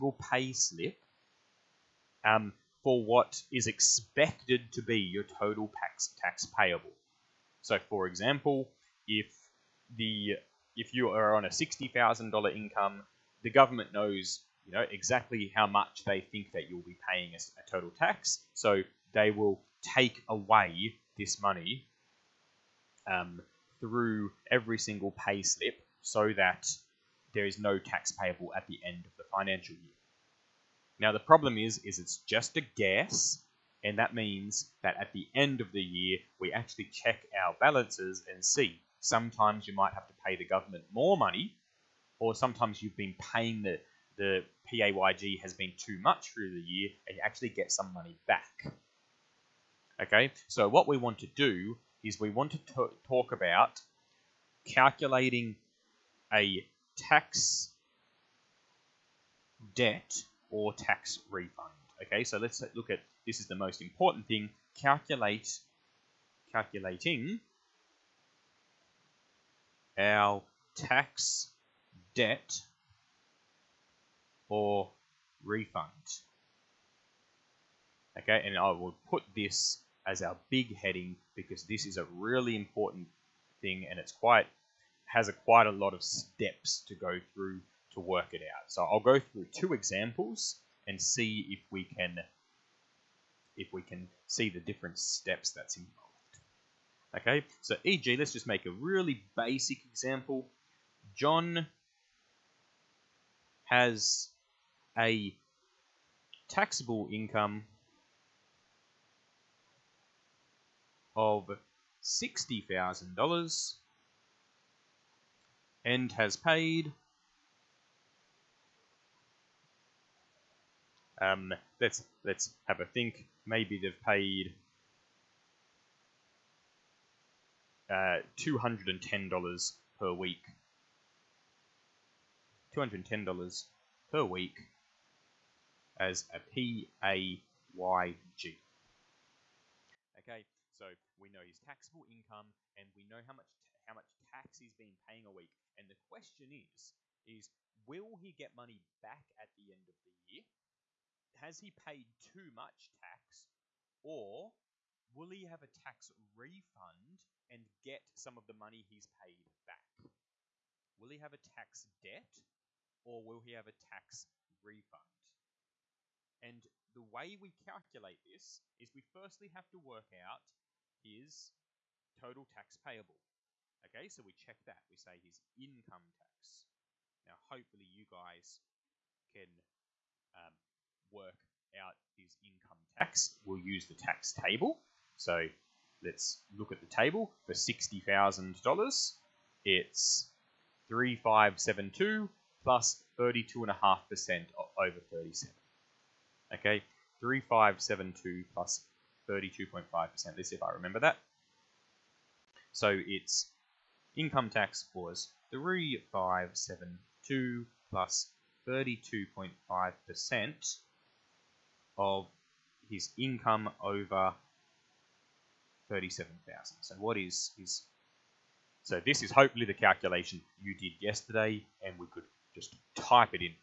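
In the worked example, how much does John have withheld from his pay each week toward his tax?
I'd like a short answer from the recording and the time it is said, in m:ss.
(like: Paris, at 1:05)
$210, at 2:12.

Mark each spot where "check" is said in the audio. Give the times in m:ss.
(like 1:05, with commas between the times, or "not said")
0:36, 2:54.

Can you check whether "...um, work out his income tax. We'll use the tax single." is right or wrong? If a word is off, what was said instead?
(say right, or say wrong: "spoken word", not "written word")
wrong: "table", not "single".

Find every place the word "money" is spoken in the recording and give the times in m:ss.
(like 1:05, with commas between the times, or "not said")
0:21, 0:41, 0:47, 2:28, 2:38.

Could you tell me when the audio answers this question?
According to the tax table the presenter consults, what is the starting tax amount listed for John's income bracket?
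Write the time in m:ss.
3:10.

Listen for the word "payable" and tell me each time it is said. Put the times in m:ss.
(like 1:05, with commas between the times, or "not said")
0:06, 0:28, 2:52.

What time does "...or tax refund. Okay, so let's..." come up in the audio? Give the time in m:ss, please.
1:00.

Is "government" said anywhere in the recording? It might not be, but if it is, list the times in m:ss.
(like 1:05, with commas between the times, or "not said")
0:13, 0:40.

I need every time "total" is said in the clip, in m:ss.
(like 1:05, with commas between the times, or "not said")
0:05, 0:17, 2:52.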